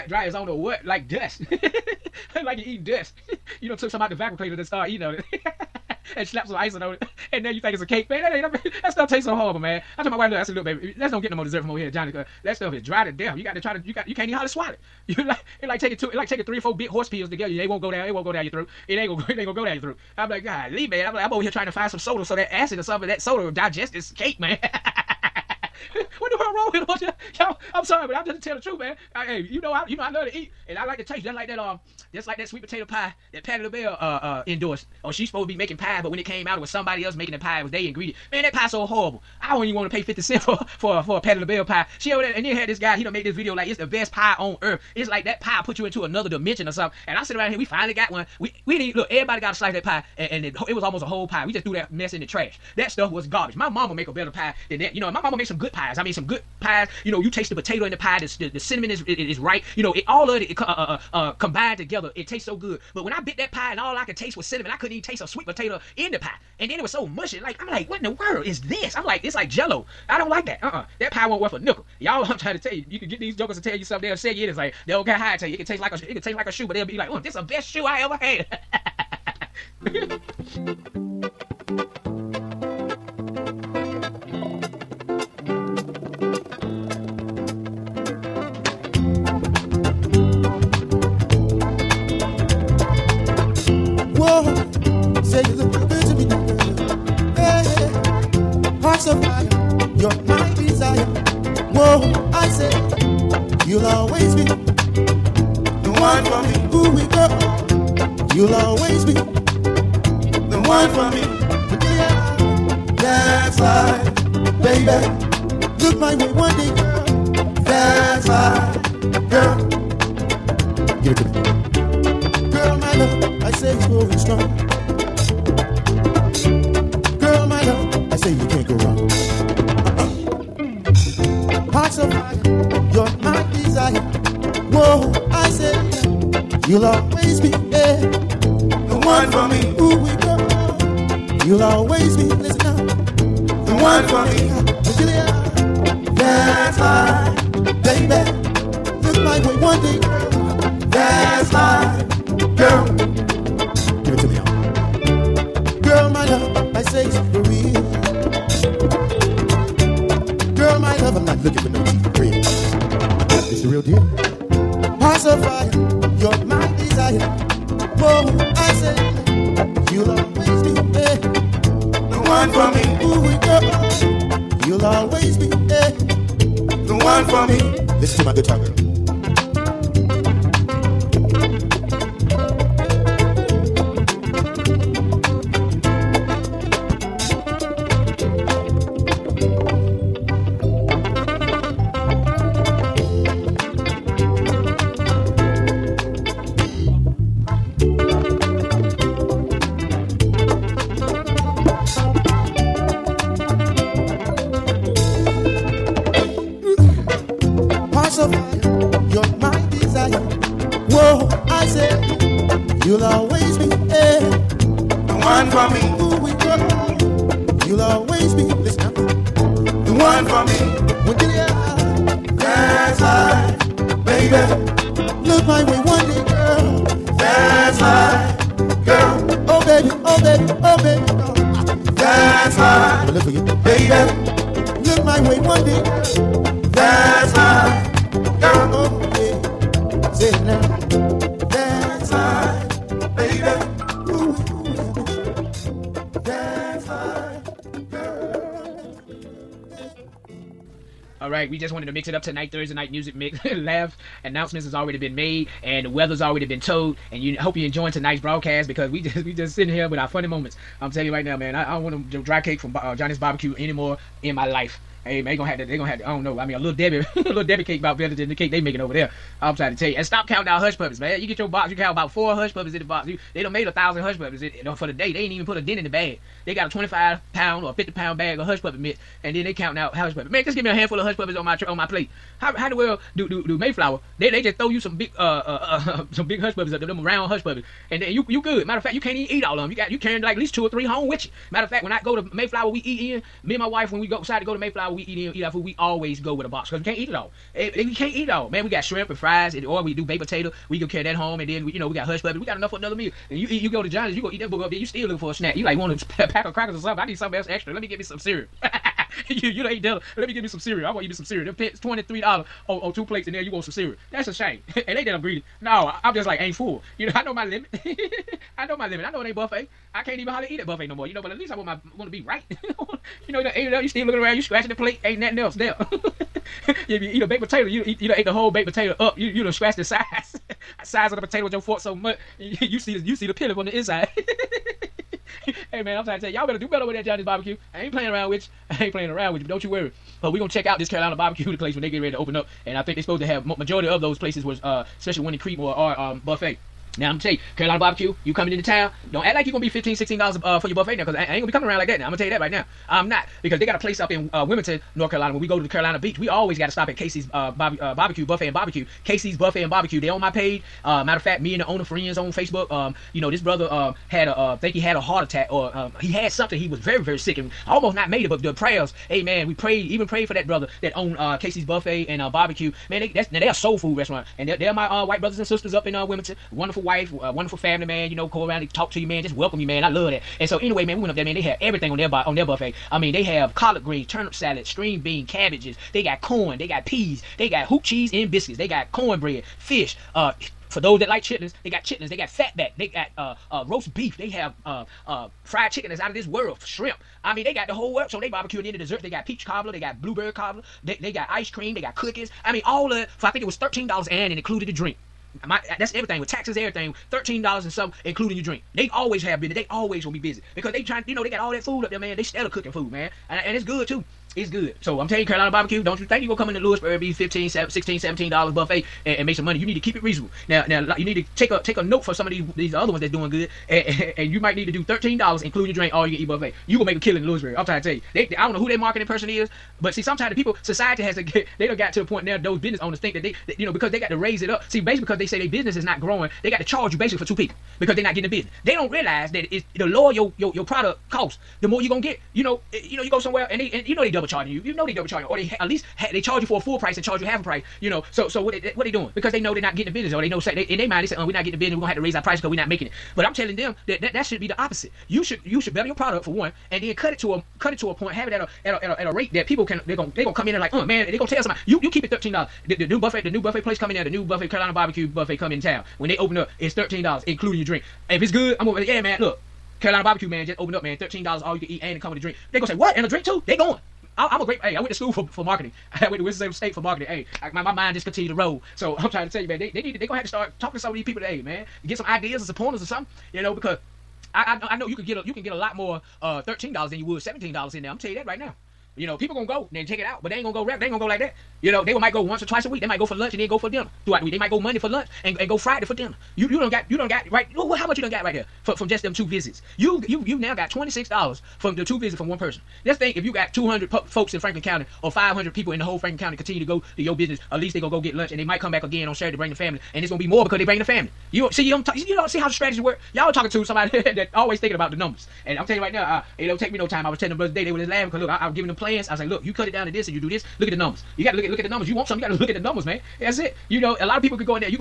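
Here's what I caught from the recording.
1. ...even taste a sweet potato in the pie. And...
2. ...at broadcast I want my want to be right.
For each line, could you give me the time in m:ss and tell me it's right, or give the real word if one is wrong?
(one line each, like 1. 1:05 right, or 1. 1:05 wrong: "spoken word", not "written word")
1. 1:04 right
2. 5:21 wrong: "least", not "broadcast".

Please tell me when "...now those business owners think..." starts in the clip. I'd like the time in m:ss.
7:12.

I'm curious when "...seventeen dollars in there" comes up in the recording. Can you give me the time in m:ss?
8:07.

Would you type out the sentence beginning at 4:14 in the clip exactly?
Announcements has already been made, and the weather's already been told.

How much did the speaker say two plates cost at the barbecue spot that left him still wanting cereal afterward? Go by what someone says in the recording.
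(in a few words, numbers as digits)
$23.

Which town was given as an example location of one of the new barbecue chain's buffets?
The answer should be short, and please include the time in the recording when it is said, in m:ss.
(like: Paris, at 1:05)
Creedmoor, at 5:45.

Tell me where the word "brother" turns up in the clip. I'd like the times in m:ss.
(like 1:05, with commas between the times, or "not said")
6:03, 6:10, 6:15, 8:37.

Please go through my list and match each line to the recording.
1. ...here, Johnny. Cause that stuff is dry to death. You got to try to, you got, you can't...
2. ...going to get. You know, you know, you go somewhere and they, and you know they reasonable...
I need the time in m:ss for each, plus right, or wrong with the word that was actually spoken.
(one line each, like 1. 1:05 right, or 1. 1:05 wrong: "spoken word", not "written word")
1. 0:11 right
2. 7:21 wrong: "double", not "reasonable".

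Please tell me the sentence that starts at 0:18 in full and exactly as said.
It won't go down your throat.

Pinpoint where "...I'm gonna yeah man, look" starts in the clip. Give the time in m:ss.
7:48.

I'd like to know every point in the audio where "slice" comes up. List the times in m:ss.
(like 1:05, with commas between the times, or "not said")
0:49.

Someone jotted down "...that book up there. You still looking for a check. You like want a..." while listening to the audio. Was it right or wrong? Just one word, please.
wrong.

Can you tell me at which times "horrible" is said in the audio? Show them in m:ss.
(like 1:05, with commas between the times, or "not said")
0:09, 0:38.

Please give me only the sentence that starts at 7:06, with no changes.
You gonna make a killing in Louisburg.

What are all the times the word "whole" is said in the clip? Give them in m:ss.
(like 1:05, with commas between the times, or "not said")
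0:51, 5:28, 6:37, 8:25.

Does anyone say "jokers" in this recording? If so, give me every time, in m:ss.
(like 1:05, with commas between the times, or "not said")
1:13.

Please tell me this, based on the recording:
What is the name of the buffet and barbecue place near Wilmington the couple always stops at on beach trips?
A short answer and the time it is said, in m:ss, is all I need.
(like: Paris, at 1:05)
Casey's Buffet and Barbecue, at 5:59.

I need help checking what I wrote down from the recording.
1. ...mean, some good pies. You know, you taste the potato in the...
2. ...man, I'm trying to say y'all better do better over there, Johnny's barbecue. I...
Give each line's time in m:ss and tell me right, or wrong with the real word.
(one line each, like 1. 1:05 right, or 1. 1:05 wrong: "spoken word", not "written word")
1. 0:56 right
2. 5:35 right.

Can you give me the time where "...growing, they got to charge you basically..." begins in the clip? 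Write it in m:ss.
7:16.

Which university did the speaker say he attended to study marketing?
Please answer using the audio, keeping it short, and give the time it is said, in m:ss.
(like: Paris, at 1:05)
Winston-Salem State, at 7:56.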